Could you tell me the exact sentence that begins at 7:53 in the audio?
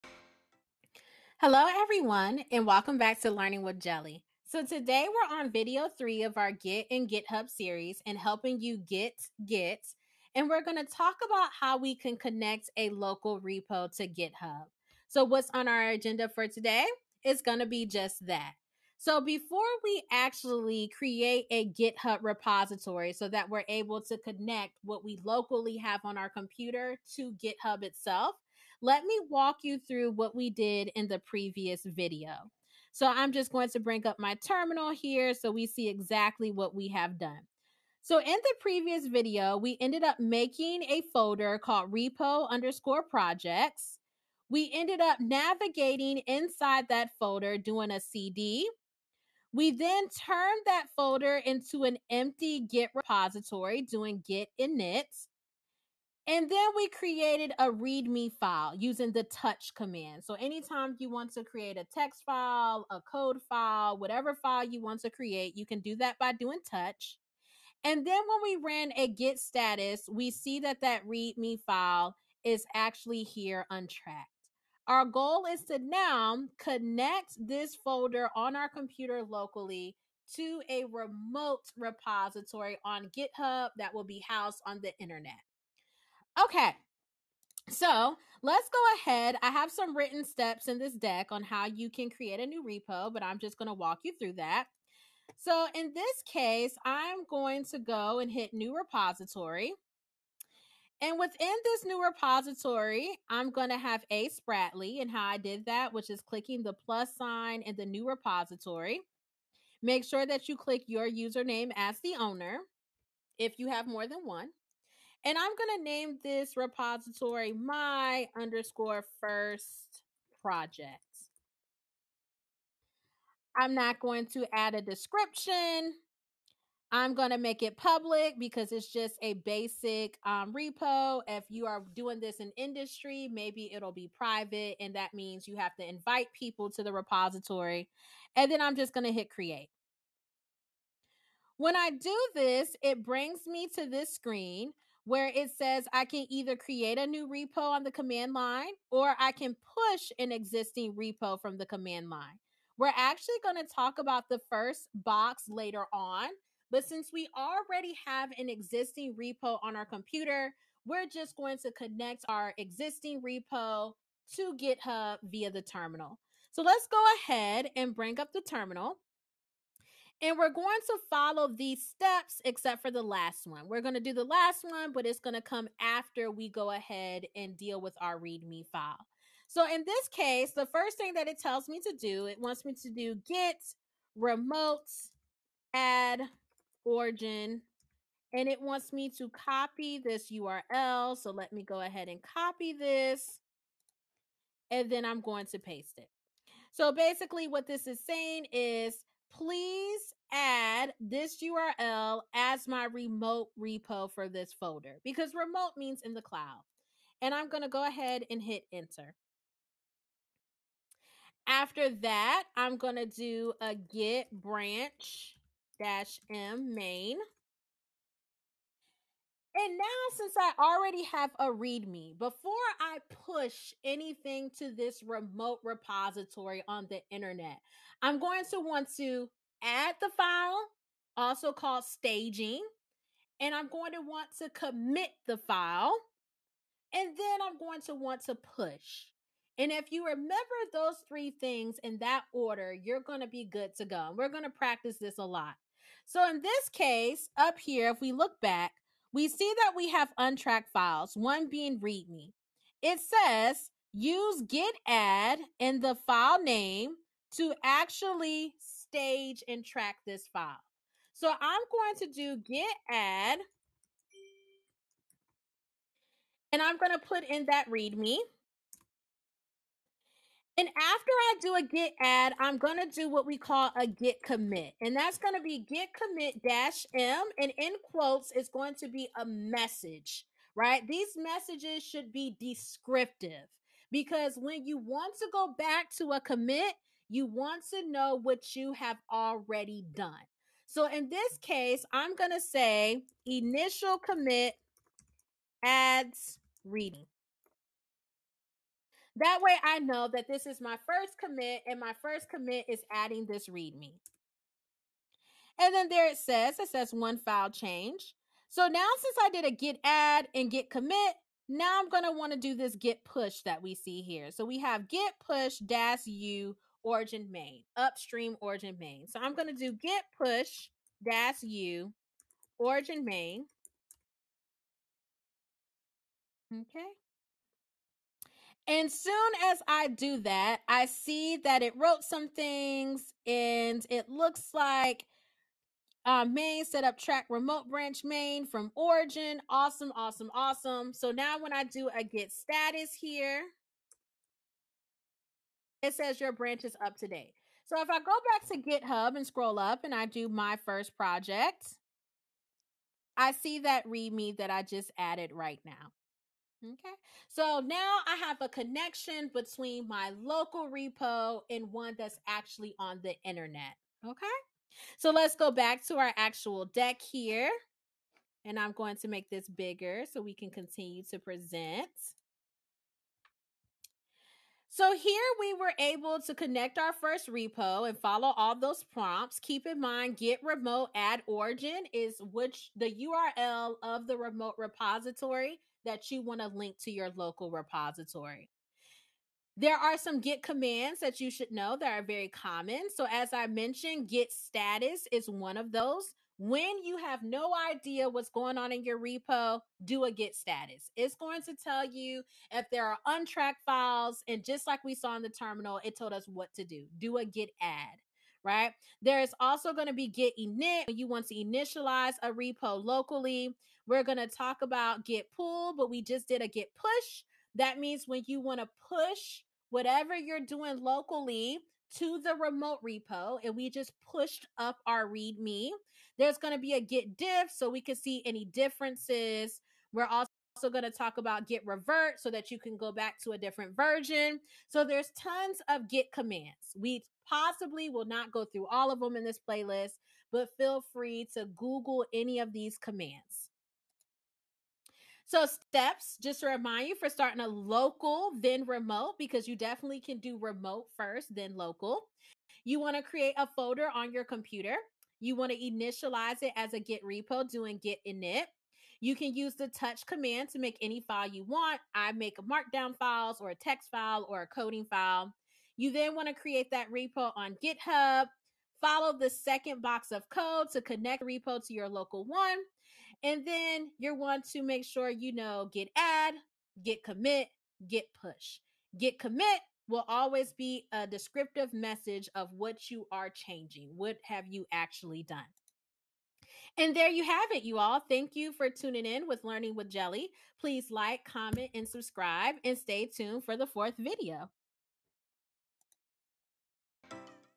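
And then you want to make sure you know git add, git commit, git push.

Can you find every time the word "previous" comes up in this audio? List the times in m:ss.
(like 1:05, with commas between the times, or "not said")
0:31, 0:38.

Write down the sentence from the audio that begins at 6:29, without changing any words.
There are some Git commands that you should know that are very common.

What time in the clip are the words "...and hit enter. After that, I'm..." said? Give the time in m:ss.
3:28.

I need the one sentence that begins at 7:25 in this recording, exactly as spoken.
So, steps, just to remind you for starting a local, then remote, because you definitely can do remote first, then local.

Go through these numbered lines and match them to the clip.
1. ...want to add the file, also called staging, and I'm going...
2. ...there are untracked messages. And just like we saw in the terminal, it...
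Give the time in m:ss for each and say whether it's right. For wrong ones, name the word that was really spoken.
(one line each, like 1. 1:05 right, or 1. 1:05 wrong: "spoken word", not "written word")
1. 3:48 right
2. 6:42 wrong: "files", not "messages".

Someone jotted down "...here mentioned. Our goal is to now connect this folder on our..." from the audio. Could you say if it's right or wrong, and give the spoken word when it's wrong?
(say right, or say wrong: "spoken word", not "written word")
wrong: "untracked", not "mentioned".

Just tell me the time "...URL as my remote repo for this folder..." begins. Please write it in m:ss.
3:21.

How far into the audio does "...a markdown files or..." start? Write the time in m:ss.
7:42.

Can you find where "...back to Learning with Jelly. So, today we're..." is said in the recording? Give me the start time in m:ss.
0:02.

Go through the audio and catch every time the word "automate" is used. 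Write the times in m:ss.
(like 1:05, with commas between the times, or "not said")
not said.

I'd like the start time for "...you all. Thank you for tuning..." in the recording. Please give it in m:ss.
8:07.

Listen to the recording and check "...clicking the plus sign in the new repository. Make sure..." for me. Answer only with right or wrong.
right.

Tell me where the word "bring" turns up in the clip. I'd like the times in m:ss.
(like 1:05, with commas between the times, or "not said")
0:33, 2:23, 2:47.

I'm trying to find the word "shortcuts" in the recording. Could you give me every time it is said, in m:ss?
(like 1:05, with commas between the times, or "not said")
not said.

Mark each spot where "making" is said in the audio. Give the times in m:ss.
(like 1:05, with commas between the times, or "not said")
0:40.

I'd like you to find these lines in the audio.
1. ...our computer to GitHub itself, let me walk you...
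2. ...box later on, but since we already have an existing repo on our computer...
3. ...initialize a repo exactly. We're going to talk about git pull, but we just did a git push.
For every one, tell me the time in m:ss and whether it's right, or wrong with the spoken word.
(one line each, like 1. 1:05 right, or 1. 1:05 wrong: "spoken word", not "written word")
1. 0:26 right
2. 2:34 right
3. 6:51 wrong: "locally", not "exactly".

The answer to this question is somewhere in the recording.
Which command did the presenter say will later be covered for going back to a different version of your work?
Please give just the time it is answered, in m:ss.
7:11.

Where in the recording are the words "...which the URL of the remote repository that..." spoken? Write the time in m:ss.
6:22.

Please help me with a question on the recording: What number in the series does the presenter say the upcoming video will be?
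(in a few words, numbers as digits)
4.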